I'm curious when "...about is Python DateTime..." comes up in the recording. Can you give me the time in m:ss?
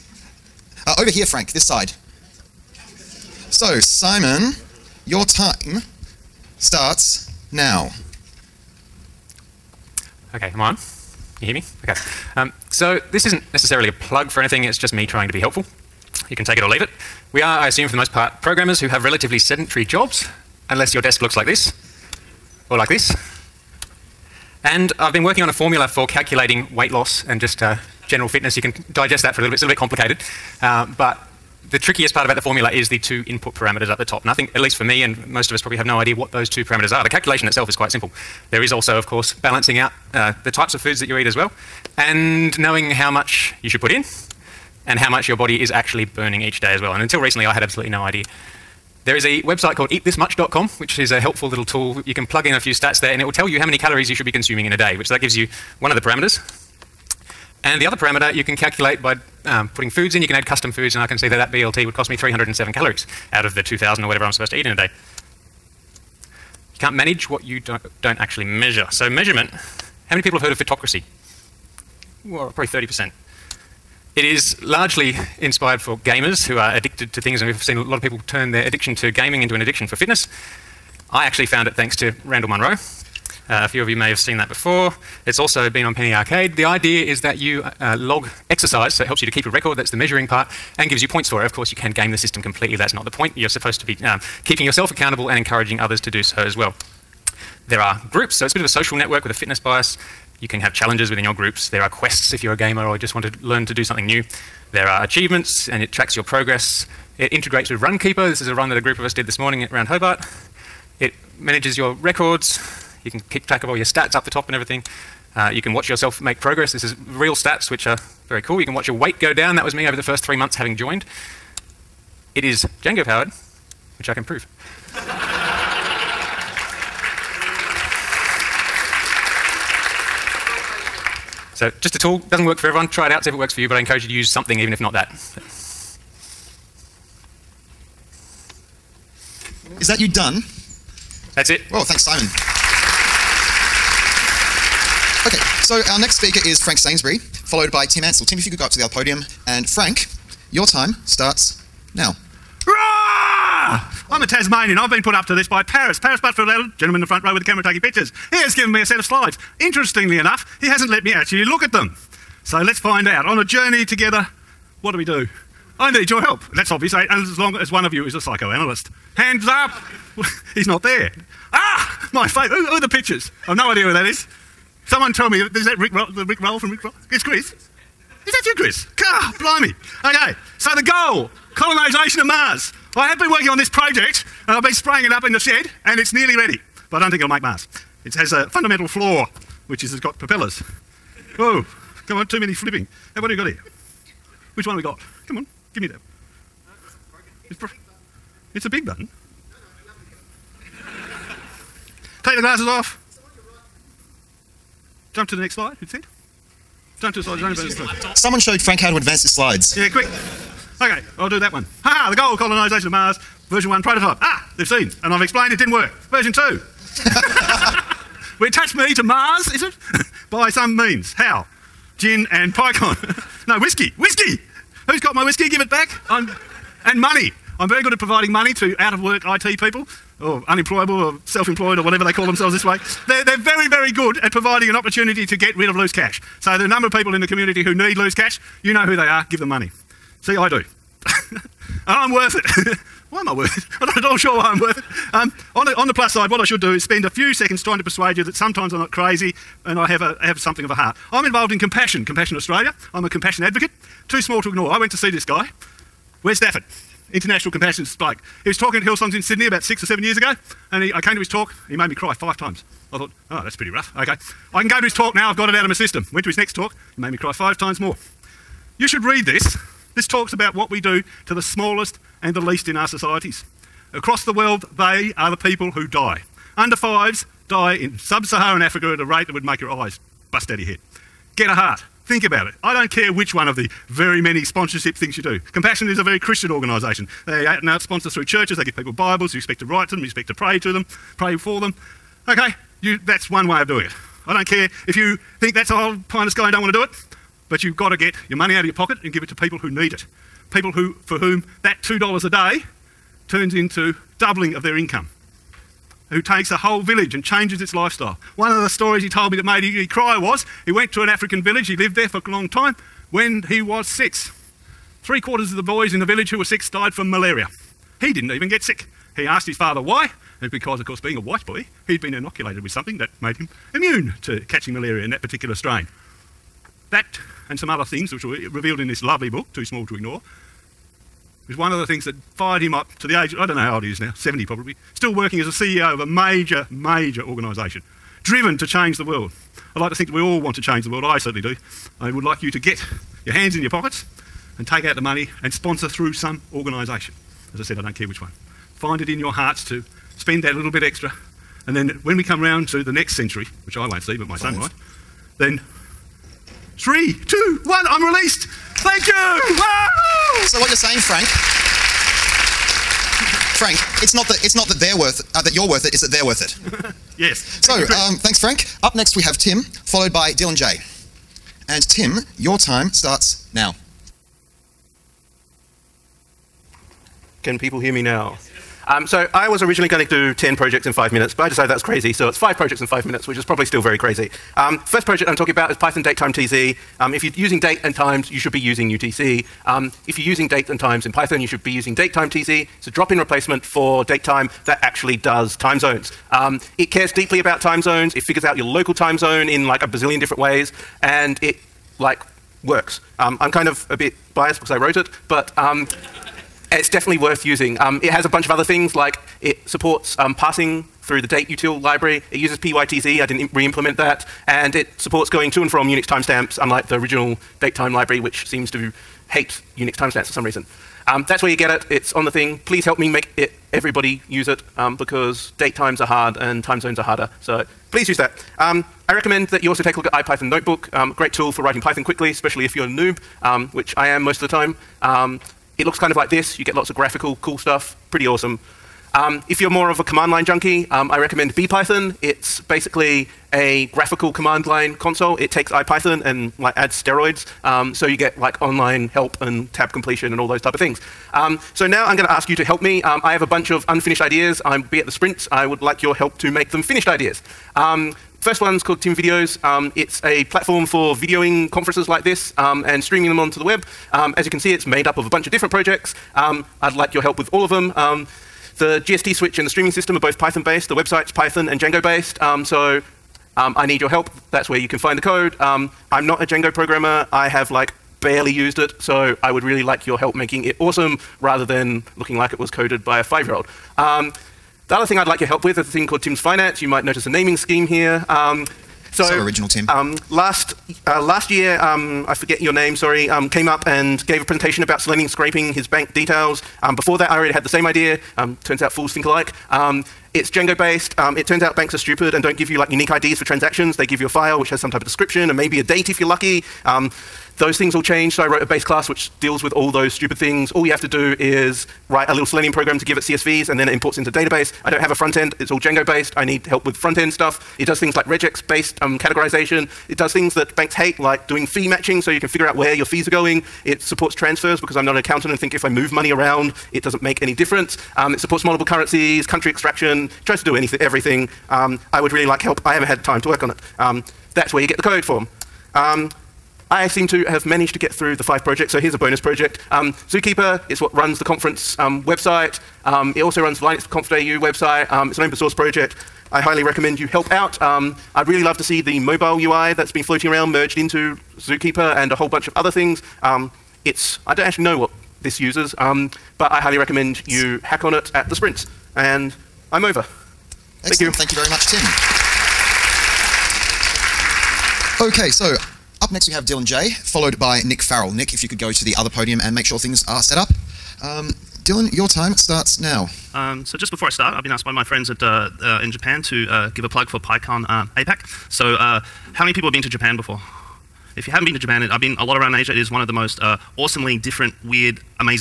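6:25.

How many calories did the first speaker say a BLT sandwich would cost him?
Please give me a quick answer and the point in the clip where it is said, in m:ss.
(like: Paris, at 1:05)
307, at 1:02.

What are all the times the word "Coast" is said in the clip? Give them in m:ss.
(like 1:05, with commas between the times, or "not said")
not said.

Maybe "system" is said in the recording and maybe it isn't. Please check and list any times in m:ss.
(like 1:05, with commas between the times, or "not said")
1:32, 4:25, 7:49.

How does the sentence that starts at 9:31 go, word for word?
Um, Dylan, your time starts now.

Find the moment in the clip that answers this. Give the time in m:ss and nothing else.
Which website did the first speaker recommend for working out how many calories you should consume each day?
0:49.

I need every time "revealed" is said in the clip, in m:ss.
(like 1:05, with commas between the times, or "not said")
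5:28.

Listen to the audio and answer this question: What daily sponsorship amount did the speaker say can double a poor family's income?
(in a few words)
$2.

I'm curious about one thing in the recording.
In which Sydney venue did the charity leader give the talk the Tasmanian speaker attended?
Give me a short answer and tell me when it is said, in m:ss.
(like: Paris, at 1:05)
Hillsongs, at 4:18.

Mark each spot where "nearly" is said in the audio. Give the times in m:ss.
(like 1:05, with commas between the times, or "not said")
3:06.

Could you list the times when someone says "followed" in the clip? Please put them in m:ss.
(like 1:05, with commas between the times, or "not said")
2:27, 6:09, 9:27.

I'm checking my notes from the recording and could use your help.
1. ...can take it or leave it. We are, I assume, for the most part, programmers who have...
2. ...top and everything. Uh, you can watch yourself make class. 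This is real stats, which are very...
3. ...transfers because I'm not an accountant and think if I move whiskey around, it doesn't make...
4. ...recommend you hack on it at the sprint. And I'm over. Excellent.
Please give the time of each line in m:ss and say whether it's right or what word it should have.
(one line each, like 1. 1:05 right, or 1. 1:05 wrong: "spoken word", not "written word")
1. 0:16 right
2. 1:54 wrong: "progress", not "class"
3. 8:44 wrong: "money", not "whiskey"
4. 9:16 right.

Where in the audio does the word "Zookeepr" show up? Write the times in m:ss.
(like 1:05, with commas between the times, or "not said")
9:00, 9:11.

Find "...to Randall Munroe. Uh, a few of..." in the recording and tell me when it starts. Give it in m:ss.
1:21.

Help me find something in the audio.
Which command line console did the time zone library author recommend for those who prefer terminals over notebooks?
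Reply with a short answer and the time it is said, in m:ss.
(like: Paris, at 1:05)
BPython, at 7:21.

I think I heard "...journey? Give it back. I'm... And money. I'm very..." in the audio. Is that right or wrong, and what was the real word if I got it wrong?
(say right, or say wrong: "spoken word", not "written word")
wrong: "whiskey", not "journey".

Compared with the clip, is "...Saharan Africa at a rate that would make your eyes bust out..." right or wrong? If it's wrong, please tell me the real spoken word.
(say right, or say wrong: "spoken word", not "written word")
right.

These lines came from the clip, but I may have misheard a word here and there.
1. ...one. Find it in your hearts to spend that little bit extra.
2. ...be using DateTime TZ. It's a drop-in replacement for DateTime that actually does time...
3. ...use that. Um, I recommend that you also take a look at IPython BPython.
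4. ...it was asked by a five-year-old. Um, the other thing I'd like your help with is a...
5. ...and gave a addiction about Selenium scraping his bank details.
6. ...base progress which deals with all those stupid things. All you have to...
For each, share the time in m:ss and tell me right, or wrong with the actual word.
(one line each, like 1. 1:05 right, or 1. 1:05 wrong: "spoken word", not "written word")
1. 5:48 right
2. 6:31 right
3. 7:08 wrong: "Notebook", not "BPython"
4. 8:02 wrong: "coded", not "asked"
5. 8:13 wrong: "presentation", not "addiction"
6. 8:28 wrong: "class", not "progress".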